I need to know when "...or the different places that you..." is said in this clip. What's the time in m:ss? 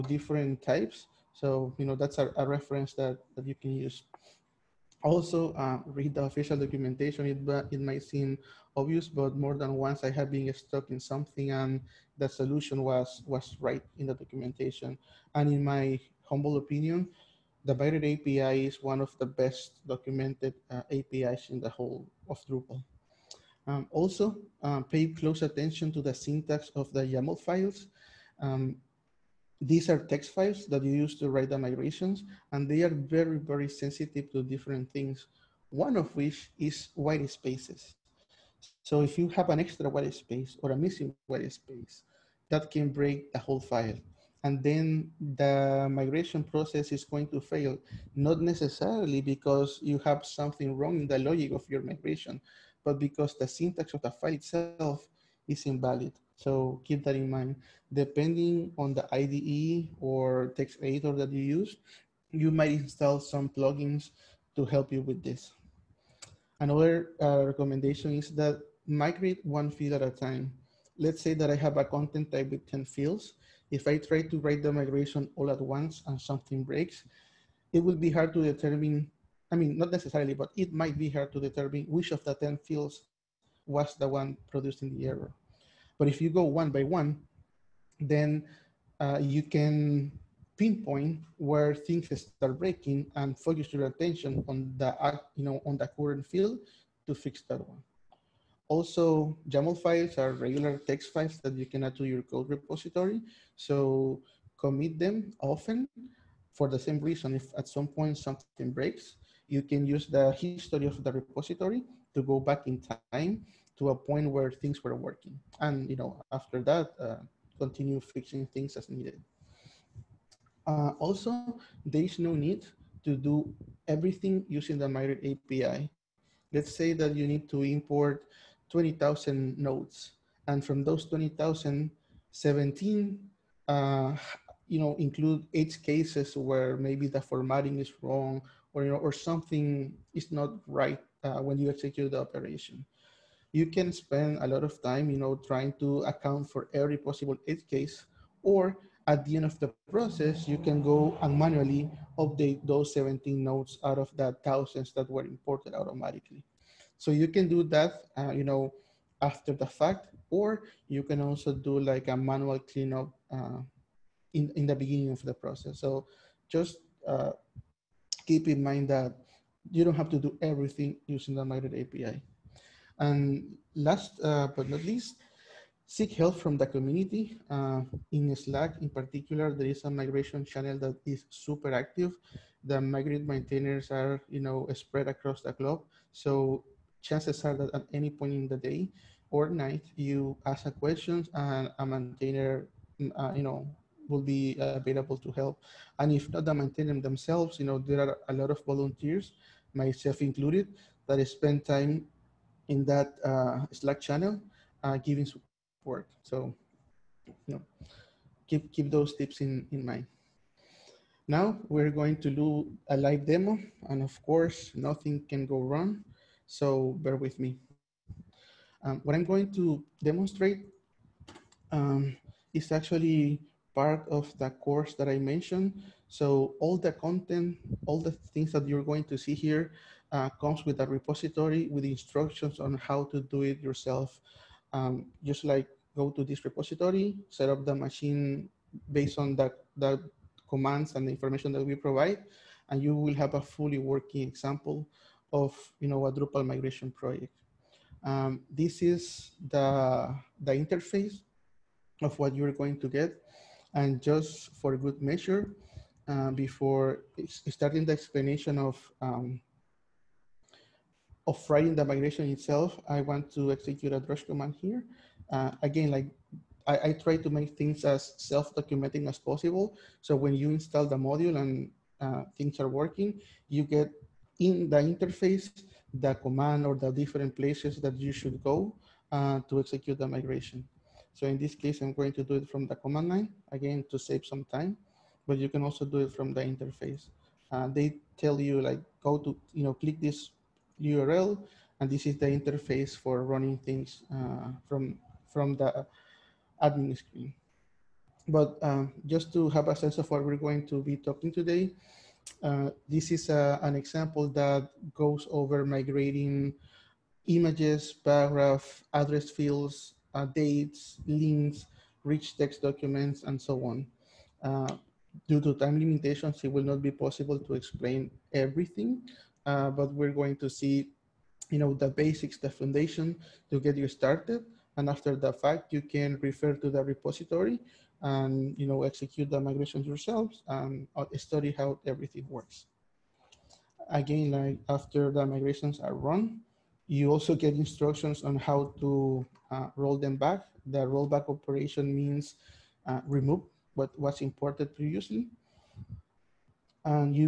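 4:36.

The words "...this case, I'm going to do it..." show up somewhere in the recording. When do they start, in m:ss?
4:41.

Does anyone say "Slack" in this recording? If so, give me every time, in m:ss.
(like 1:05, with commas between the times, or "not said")
2:58, 3:23.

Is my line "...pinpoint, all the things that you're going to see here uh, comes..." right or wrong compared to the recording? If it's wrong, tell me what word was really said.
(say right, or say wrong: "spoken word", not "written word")
wrong: "content", not "pinpoint".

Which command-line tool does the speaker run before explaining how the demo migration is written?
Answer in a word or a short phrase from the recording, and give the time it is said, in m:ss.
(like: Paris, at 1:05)
drush, at 4:23.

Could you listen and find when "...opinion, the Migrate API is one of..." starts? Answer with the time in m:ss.
0:16.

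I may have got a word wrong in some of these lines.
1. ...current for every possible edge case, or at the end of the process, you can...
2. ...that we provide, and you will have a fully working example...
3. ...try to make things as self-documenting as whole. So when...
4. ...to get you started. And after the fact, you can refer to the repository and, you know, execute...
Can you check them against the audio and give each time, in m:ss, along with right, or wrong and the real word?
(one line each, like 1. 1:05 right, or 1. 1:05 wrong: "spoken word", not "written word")
1. 2:26 wrong: "account", not "current"
2. 4:01 right
3. 4:27 wrong: "possible", not "whole"
4. 5:23 right.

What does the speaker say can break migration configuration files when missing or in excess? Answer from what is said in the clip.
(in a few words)
White spaces.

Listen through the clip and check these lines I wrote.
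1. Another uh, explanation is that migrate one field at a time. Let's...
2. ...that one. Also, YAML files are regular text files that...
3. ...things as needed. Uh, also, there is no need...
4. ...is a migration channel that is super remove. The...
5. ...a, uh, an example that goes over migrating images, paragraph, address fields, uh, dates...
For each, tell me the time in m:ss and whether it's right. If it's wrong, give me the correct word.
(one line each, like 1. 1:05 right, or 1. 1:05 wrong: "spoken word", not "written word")
1. 1:06 wrong: "recommendation", not "explanation"
2. 1:37 right
3. 1:58 right
4. 2:59 wrong: "active", not "remove"
5. 5:03 right.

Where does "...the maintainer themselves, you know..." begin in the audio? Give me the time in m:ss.
3:16.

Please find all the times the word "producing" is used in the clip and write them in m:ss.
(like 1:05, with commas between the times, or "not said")
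1:24.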